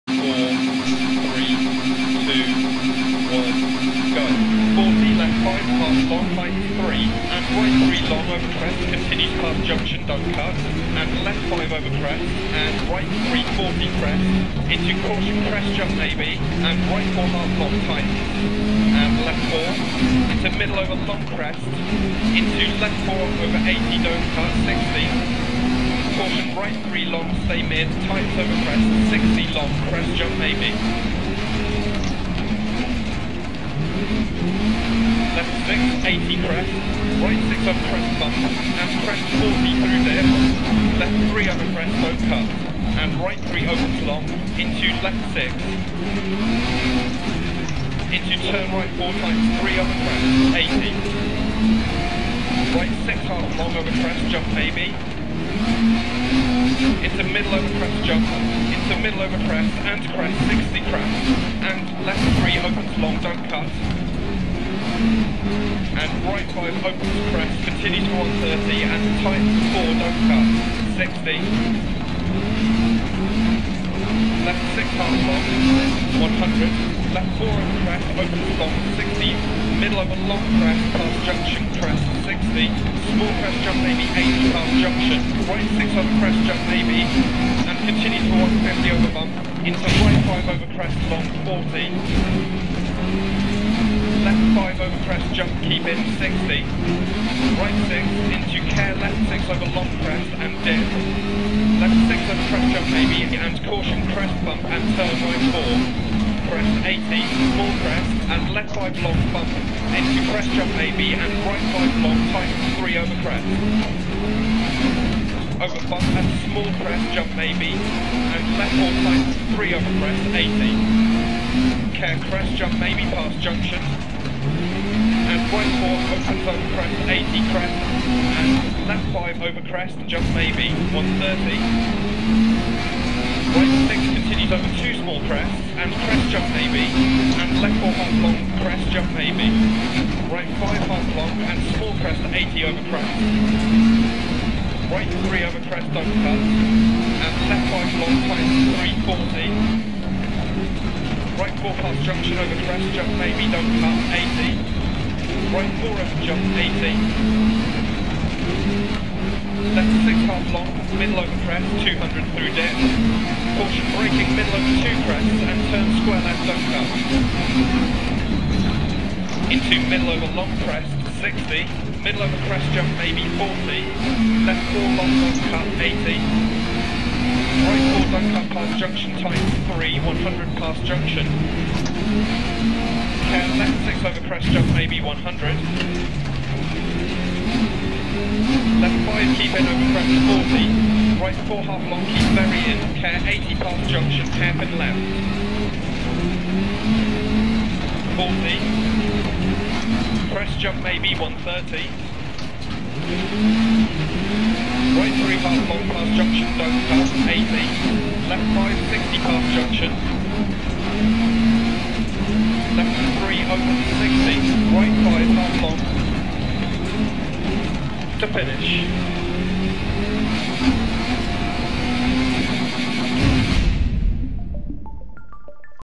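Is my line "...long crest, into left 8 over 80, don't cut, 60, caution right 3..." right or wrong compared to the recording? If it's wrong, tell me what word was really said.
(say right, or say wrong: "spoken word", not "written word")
wrong: "4", not "8".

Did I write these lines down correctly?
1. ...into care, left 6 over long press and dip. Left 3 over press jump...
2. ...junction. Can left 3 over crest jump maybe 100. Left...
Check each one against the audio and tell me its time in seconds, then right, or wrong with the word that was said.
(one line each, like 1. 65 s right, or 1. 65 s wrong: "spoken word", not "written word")
1. 98 s wrong: "6", not "3"
2. 180 s wrong: "6", not "3".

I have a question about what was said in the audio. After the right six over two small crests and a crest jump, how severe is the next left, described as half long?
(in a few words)
left 4.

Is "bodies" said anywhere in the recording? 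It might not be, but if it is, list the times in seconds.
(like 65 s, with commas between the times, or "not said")
not said.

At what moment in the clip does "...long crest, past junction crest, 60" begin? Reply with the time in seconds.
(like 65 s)
80 s.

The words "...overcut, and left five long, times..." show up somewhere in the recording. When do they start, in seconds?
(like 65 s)
146 s.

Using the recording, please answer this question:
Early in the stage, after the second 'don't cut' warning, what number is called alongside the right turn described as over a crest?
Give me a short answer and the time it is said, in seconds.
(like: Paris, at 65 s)
340, at 12 s.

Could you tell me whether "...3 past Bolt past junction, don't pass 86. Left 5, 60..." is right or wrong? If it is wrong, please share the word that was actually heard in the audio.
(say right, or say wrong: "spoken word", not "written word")
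wrong: "80", not "86".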